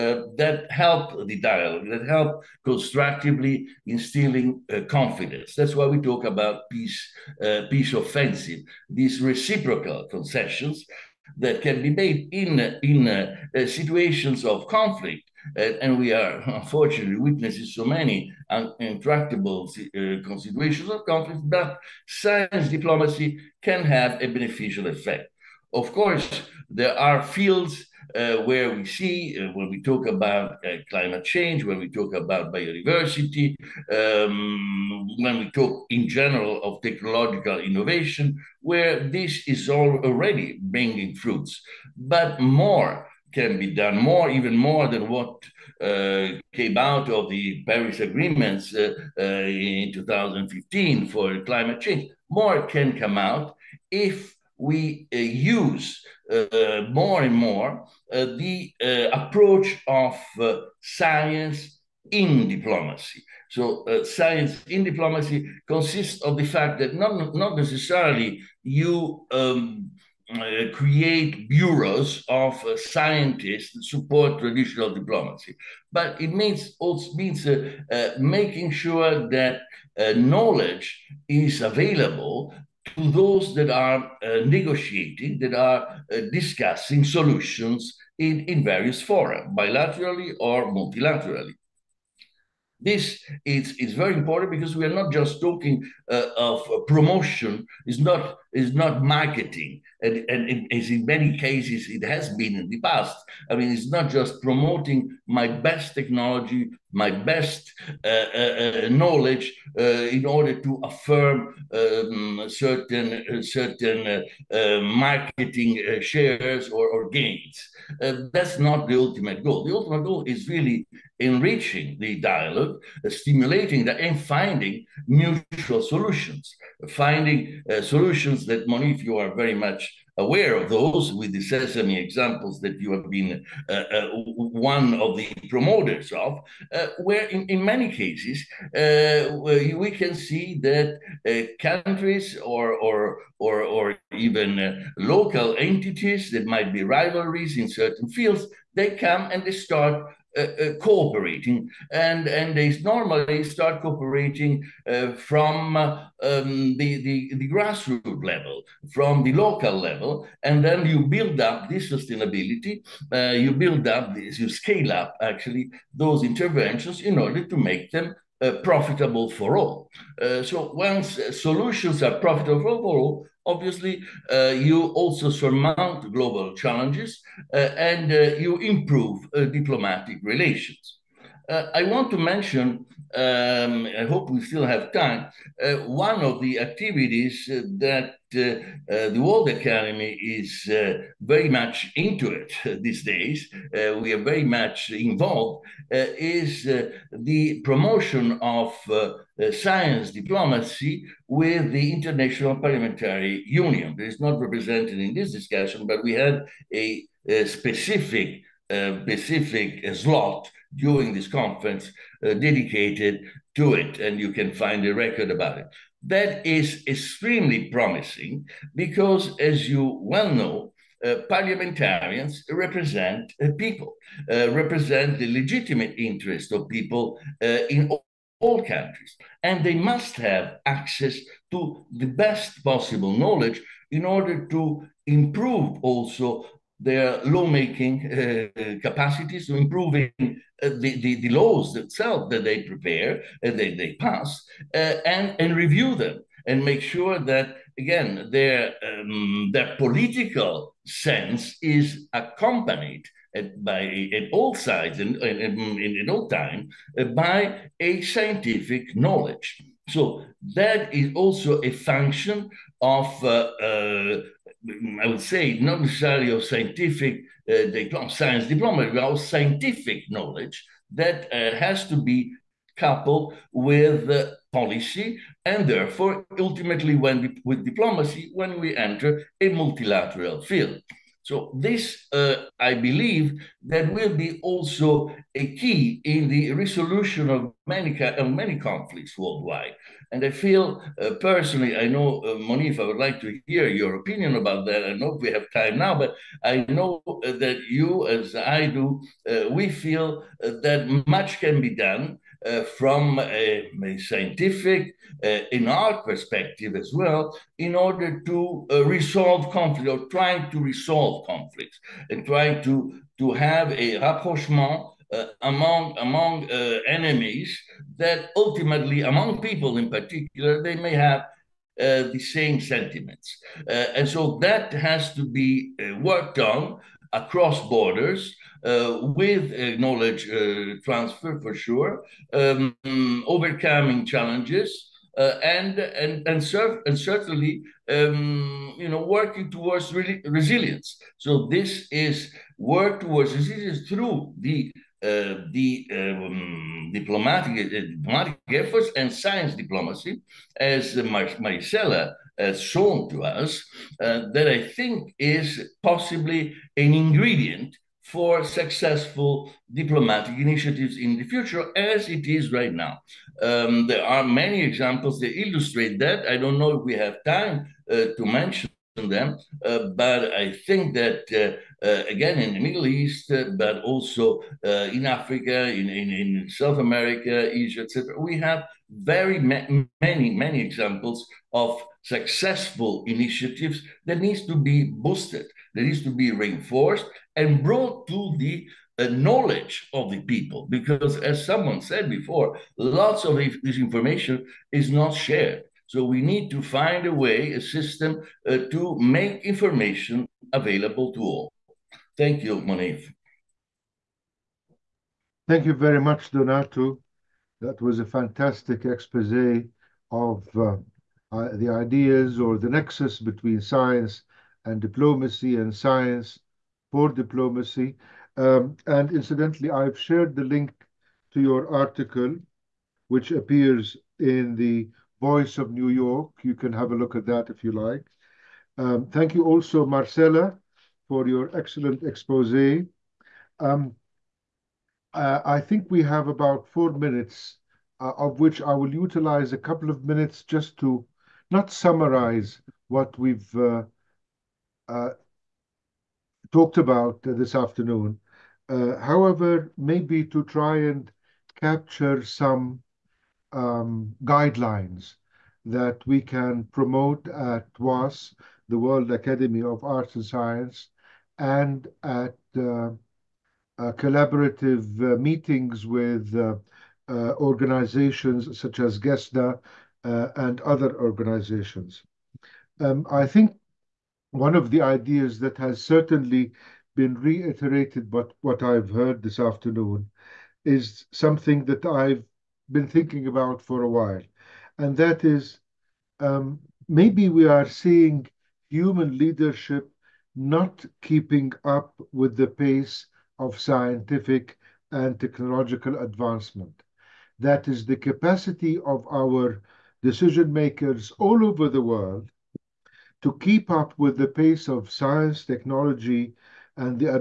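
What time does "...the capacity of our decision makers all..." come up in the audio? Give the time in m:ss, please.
8:17.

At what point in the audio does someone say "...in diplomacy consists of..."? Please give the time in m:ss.
1:04.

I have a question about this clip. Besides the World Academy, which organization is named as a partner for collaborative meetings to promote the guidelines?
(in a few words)
GESDA.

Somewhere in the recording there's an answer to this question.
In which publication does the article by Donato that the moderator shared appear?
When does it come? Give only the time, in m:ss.
7:05.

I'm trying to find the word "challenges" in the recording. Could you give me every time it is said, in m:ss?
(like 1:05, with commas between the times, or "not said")
2:56, 5:34.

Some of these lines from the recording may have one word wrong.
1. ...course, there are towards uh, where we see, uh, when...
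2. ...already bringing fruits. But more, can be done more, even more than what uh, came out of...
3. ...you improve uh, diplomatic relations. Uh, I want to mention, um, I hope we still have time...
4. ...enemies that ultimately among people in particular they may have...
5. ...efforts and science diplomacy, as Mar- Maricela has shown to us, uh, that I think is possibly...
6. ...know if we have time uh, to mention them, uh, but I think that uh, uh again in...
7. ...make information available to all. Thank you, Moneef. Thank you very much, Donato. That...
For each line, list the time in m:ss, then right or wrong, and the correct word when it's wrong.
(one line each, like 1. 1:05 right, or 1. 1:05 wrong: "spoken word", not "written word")
1. 0:25 wrong: "fields", not "towards"
2. 0:40 right
3. 2:58 right
4. 5:16 right
5. 5:48 right
6. 6:06 right
7. 6:38 right.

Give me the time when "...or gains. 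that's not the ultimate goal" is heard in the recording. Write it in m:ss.
1:56.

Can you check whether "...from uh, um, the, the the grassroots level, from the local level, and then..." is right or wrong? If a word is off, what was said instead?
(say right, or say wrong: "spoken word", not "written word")
right.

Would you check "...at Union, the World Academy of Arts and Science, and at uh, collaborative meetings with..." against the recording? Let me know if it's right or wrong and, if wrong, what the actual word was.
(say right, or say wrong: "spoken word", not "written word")
wrong: "WAAS", not "Union".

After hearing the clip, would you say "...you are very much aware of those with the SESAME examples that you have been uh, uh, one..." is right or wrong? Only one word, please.
right.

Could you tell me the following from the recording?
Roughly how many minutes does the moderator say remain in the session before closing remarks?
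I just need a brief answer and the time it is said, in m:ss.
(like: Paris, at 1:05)
4, at 7:16.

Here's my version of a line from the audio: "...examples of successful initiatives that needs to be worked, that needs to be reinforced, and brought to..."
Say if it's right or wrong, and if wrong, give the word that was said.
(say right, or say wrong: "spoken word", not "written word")
wrong: "boosted", not "worked".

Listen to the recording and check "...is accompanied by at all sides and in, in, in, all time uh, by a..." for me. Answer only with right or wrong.
right.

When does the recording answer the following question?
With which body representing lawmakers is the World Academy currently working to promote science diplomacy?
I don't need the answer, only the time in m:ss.
3:21.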